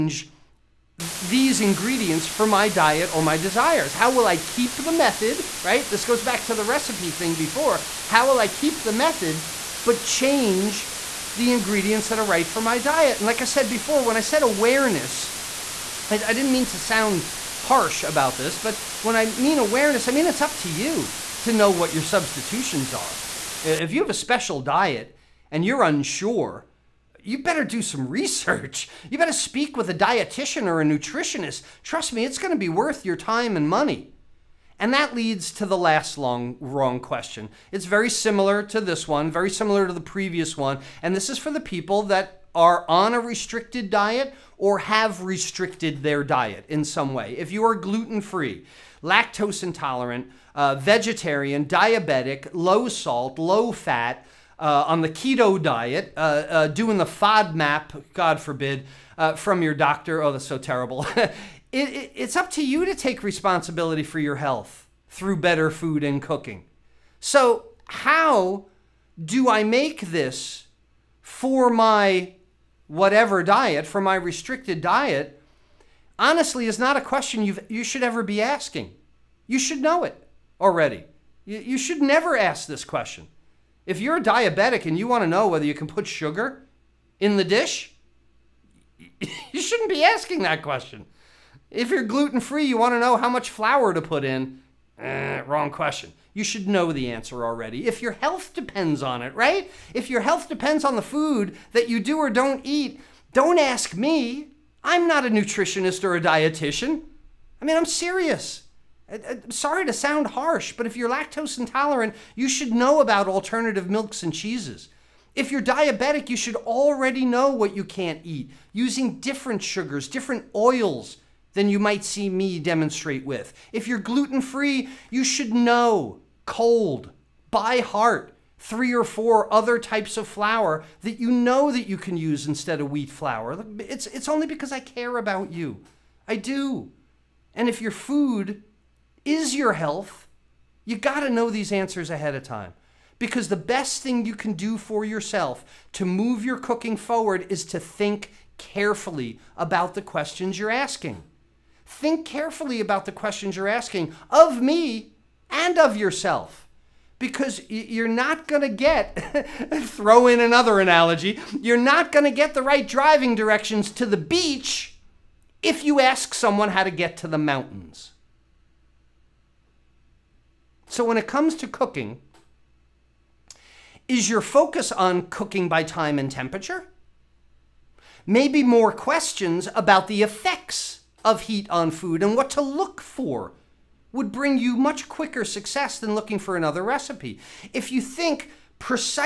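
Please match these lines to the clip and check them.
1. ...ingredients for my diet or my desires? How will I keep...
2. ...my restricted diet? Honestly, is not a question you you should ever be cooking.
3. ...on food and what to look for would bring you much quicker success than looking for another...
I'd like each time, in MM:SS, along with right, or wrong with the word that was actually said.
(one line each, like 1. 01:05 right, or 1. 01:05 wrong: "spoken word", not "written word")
1. 00:01 right
2. 01:13 wrong: "asking", not "cooking"
3. 03:01 right.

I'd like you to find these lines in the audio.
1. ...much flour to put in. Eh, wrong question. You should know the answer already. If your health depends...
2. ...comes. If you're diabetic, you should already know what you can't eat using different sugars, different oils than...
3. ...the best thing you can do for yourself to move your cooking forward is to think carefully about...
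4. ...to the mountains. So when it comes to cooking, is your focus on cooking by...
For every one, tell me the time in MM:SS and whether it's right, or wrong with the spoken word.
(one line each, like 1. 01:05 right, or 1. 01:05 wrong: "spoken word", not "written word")
1. 01:33 right
2. 01:54 wrong: "cheeses", not "comes"
3. 02:23 right
4. 02:47 right.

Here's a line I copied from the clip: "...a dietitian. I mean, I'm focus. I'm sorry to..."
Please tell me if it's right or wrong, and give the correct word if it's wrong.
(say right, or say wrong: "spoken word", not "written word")
wrong: "serious", not "focus".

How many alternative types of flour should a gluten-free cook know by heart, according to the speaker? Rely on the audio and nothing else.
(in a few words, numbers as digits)
3 or 4.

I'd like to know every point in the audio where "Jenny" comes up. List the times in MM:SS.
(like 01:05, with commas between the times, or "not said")
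not said.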